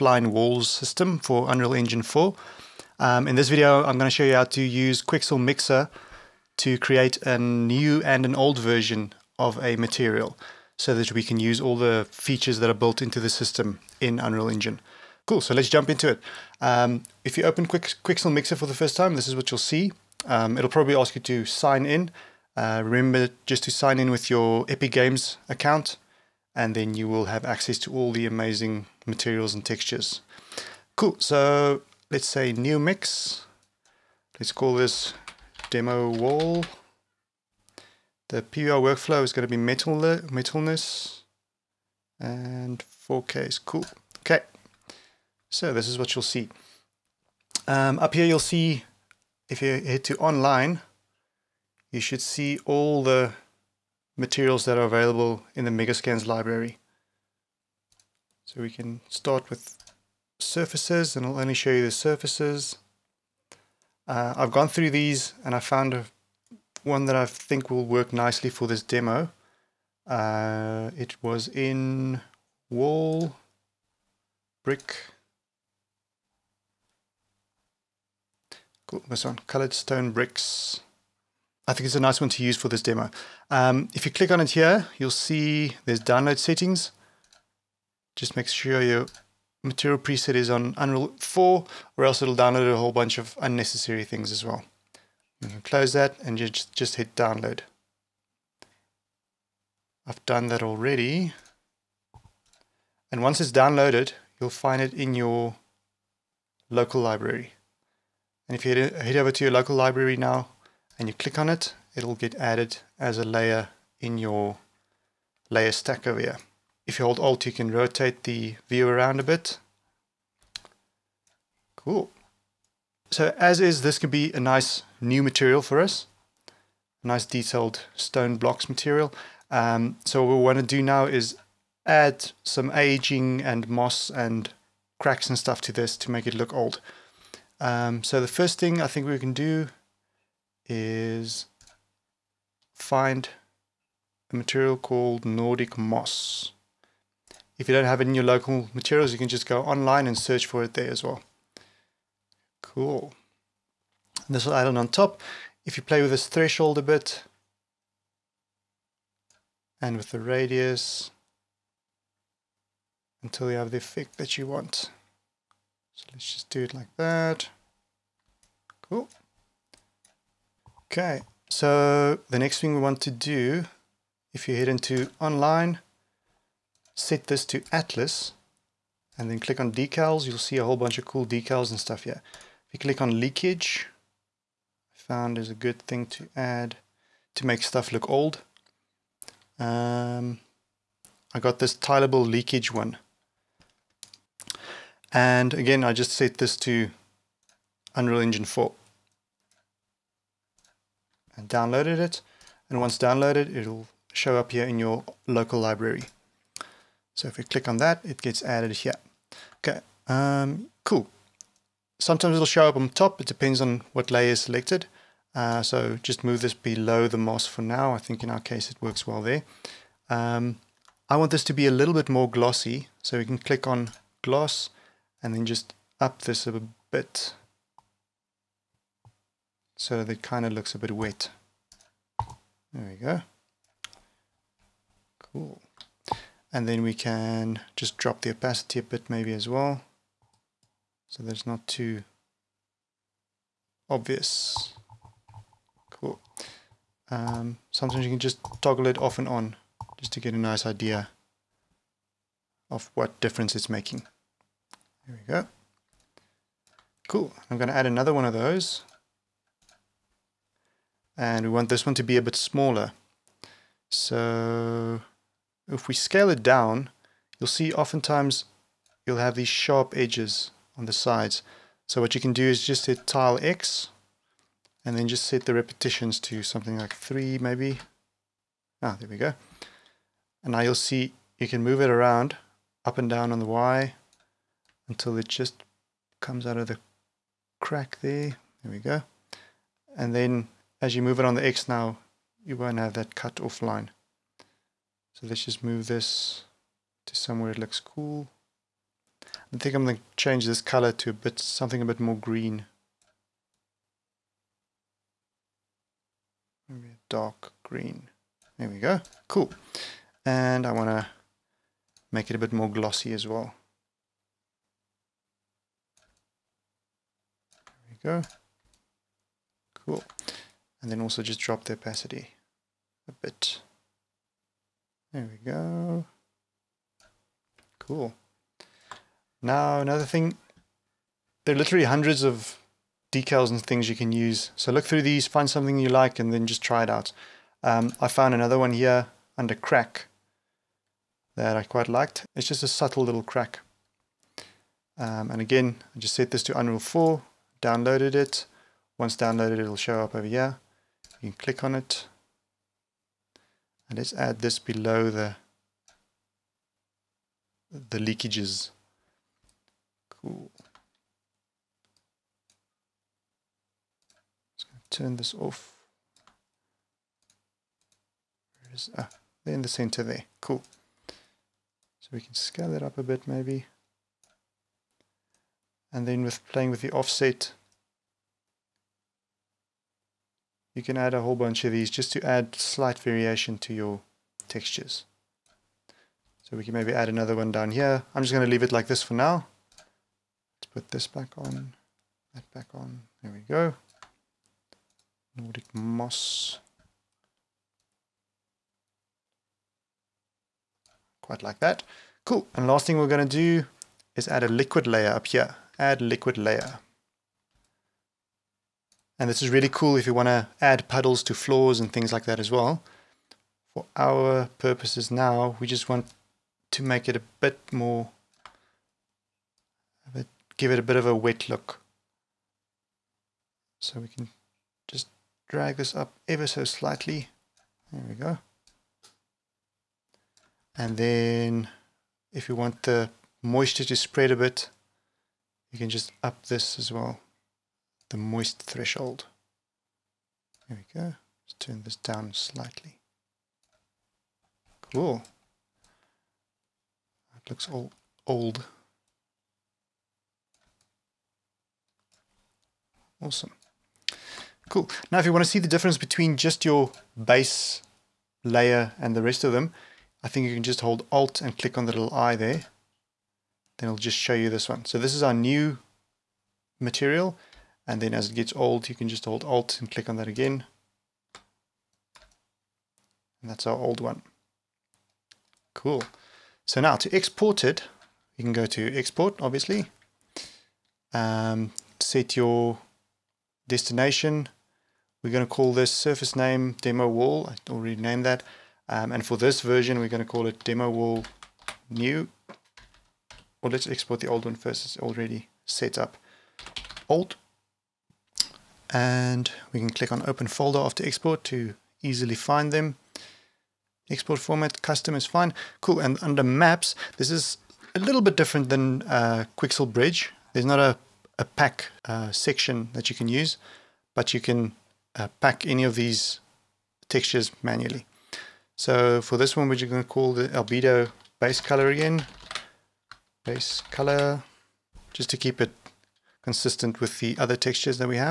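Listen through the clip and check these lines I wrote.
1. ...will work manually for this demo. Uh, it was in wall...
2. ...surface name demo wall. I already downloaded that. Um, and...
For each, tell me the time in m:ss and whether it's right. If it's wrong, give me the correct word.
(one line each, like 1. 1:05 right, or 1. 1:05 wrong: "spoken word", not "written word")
1. 1:07 wrong: "nicely", not "manually"
2. 8:05 wrong: "named", not "downloaded".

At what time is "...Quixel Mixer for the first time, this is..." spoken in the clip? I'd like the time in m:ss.
0:17.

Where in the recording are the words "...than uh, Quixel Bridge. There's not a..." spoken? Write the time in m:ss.
8:28.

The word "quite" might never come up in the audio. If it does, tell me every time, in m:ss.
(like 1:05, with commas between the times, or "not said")
5:41, 6:41.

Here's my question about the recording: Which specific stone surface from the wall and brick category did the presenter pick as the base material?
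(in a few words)
colored stone bricks.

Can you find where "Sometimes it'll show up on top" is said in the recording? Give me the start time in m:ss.
3:31.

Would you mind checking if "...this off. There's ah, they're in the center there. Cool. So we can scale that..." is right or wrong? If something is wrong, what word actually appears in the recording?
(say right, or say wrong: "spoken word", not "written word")
right.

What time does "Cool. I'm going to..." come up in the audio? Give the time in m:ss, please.
4:17.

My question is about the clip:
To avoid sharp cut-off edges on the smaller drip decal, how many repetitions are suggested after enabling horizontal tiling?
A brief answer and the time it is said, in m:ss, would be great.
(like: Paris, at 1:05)
3, at 4:36.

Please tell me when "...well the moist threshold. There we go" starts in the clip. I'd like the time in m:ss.
7:16.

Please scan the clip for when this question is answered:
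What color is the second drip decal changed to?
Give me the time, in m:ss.
5:07.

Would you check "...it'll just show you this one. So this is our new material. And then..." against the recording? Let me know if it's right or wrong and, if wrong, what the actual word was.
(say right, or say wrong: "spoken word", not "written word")
right.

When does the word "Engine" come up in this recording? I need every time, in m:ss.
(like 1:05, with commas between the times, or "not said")
0:01, 0:14, 3:18.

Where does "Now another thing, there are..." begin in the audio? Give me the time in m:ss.
5:29.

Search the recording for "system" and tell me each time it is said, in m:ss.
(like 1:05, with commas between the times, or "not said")
0:00, 0:13.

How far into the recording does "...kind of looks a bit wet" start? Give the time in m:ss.
3:50.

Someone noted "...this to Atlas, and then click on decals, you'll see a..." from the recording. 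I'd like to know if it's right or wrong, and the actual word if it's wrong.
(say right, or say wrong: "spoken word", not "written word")
right.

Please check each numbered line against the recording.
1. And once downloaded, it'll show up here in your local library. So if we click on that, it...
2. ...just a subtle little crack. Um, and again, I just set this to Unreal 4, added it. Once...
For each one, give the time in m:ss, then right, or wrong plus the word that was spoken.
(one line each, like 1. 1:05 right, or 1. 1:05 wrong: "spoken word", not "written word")
1. 3:22 right
2. 5:42 wrong: "downloaded", not "added".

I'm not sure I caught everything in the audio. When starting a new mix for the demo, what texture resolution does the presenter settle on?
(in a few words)
4K.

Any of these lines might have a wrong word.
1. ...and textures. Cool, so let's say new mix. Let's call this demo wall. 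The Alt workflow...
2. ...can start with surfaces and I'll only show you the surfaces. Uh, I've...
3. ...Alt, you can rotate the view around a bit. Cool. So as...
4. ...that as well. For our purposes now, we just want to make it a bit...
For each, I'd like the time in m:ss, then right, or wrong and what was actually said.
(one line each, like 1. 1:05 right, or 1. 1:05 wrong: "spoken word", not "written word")
1. 0:29 wrong: "PBR", not "Alt"
2. 0:58 right
3. 1:57 right
4. 6:52 right.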